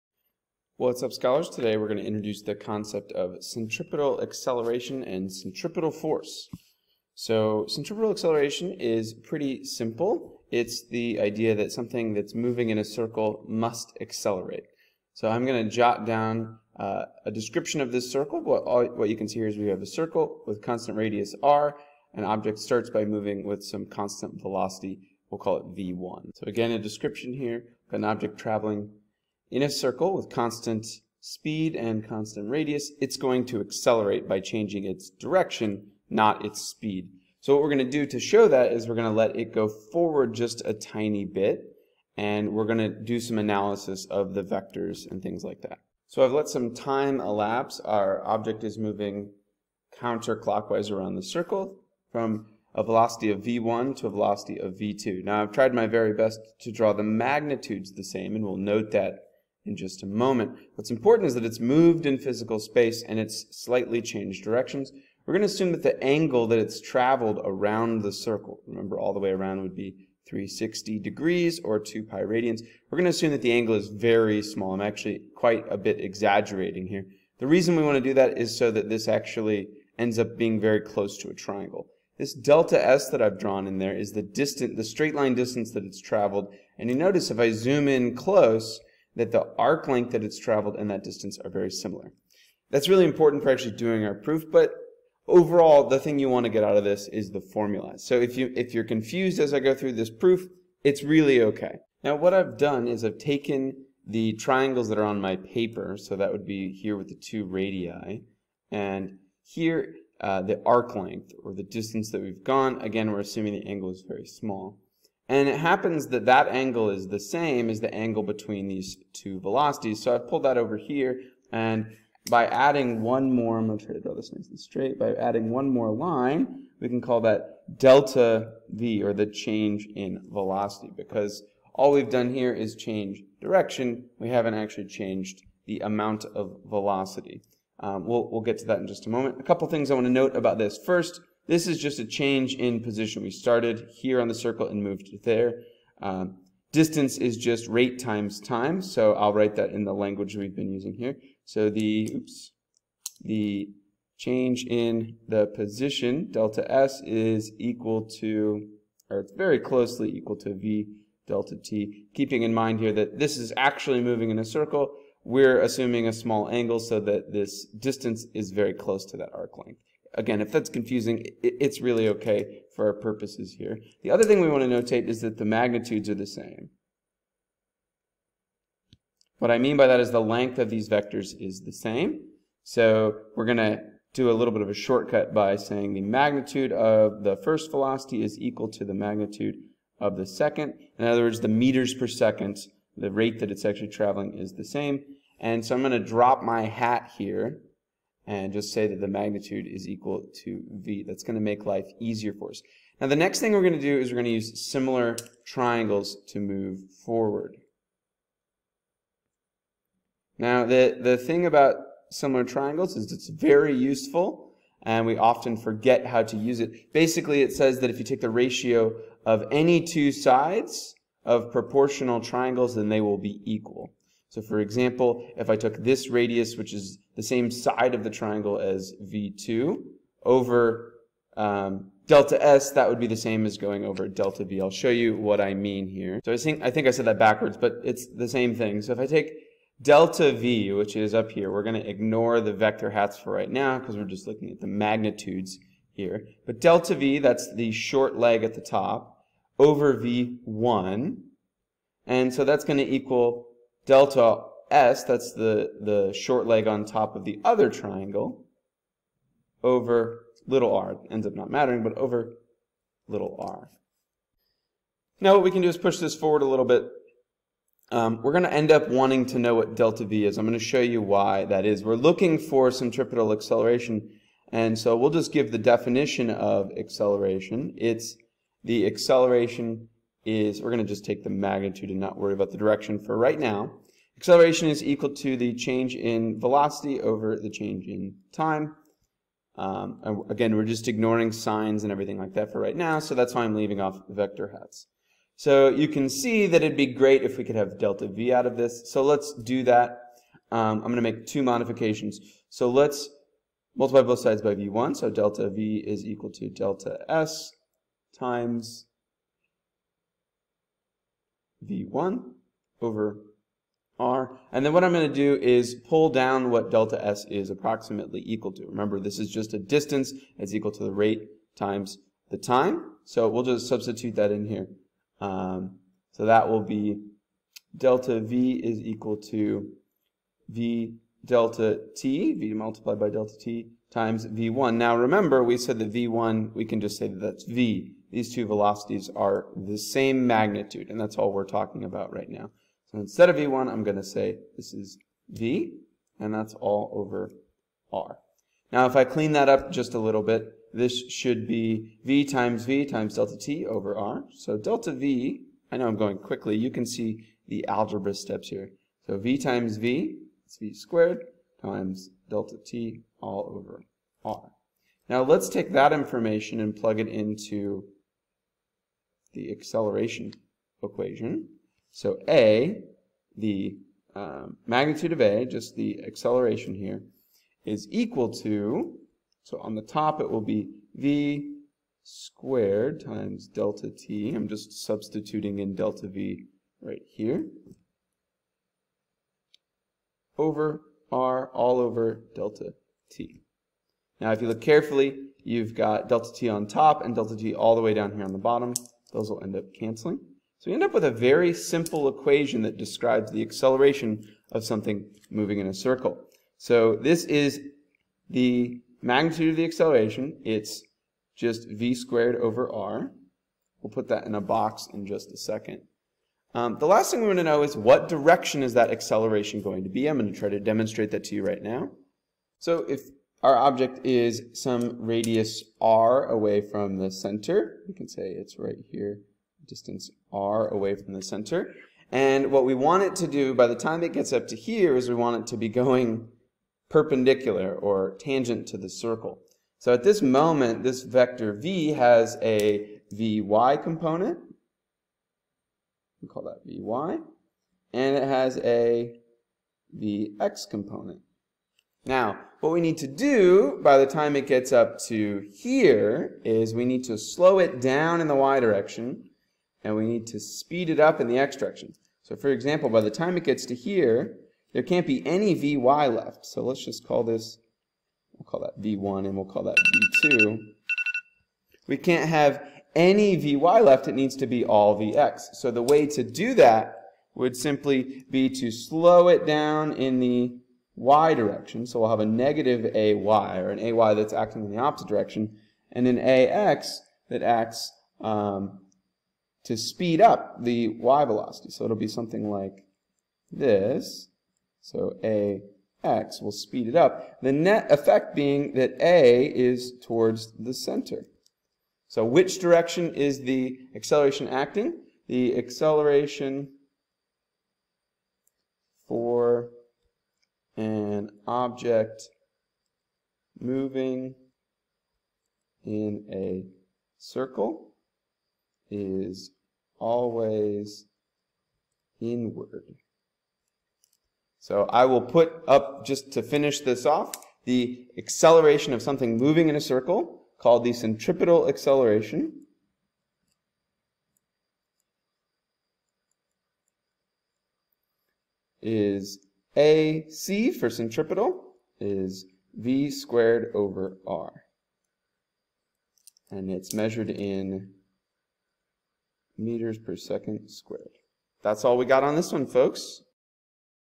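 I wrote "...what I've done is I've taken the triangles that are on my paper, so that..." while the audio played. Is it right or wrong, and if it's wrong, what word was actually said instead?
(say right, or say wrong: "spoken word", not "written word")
right.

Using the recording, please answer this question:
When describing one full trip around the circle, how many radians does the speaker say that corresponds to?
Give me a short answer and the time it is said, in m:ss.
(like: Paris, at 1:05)
2 pi radians, at 1:11.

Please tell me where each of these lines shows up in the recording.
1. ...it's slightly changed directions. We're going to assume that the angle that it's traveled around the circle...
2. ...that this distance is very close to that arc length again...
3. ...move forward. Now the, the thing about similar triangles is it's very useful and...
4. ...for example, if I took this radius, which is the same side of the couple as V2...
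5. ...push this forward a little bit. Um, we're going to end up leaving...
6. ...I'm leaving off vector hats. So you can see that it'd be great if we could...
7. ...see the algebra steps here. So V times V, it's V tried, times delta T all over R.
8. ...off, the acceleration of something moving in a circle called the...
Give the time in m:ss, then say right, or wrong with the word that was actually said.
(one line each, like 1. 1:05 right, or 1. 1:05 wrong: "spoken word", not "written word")
1. 1:03 right
2. 2:46 right
3. 3:26 right
4. 3:44 wrong: "triangle", not "couple"
5. 4:25 wrong: "wanting", not "leaving"
6. 4:53 right
7. 5:56 wrong: "squared", not "tried"
8. 8:47 right.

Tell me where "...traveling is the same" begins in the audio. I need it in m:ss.
3:13.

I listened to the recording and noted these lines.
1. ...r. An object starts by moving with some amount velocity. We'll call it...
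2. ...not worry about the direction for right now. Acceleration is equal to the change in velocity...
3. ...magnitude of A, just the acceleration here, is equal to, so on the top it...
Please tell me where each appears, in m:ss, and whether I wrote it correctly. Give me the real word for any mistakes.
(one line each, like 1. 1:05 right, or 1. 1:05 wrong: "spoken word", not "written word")
1. 0:21 wrong: "constant", not "amount"
2. 4:41 right
3. 6:14 right.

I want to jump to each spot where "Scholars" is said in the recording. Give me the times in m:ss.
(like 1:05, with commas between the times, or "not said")
0:01.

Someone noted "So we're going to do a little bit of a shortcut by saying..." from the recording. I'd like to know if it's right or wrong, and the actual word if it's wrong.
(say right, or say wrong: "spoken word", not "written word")
right.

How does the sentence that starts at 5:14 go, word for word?
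And then what I'm going to do is pull down what delta S is approximately equal to.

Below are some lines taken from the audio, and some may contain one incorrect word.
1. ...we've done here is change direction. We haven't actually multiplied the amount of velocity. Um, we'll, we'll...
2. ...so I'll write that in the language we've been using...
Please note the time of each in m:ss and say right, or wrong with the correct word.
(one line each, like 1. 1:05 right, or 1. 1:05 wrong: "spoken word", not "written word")
1. 2:11 wrong: "changed", not "multiplied"
2. 2:28 right.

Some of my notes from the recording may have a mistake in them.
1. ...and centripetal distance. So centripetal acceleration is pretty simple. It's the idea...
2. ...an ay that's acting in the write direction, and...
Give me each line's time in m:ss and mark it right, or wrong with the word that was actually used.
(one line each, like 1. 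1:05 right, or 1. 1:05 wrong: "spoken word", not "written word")
1. 0:05 wrong: "force", not "distance"
2. 8:03 wrong: "opposite", not "write".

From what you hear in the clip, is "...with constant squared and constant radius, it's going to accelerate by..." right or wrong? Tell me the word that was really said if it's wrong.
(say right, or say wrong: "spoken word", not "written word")
wrong: "speed", not "squared".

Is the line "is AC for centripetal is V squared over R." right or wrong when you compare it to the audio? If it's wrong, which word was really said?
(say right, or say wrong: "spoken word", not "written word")
right.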